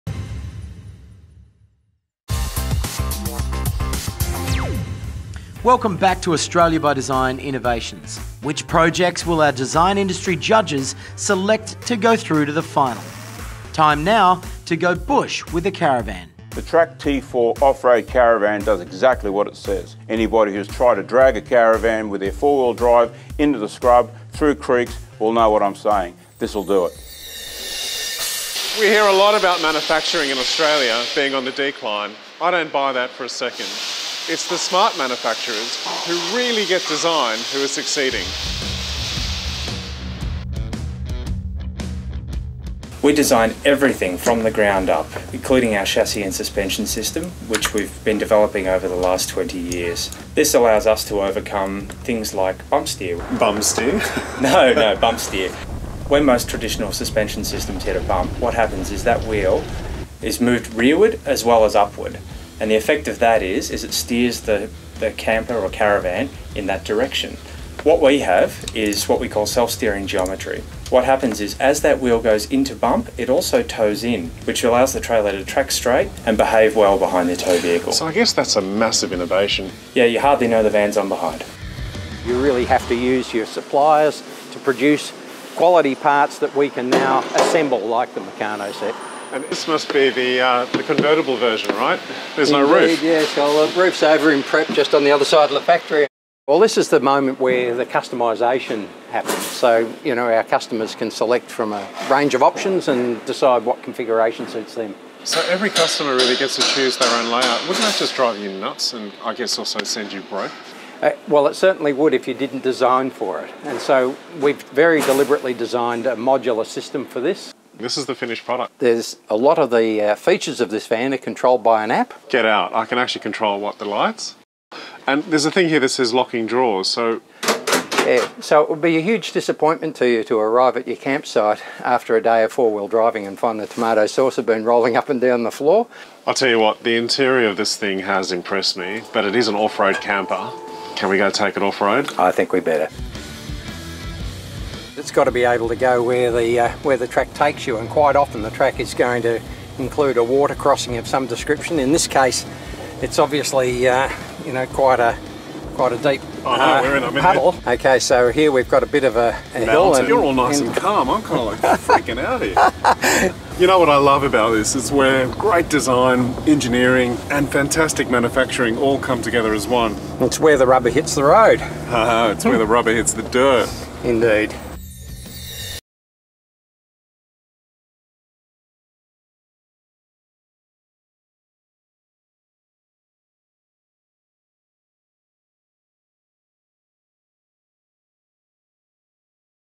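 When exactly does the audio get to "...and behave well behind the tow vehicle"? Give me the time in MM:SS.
01:16.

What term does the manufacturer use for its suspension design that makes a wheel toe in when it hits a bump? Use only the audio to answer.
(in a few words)
self-steering geometry.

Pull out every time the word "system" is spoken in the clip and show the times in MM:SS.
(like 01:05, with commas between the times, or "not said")
00:46, 00:57, 01:56.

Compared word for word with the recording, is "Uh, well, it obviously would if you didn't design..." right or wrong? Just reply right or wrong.
wrong.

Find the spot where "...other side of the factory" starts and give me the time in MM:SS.
01:35.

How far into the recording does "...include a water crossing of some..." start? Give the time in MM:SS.
02:29.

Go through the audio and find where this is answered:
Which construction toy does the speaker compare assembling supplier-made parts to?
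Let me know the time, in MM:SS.
01:28.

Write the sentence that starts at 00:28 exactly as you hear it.
We hear a lot about manufacturing in Australia being on the decline.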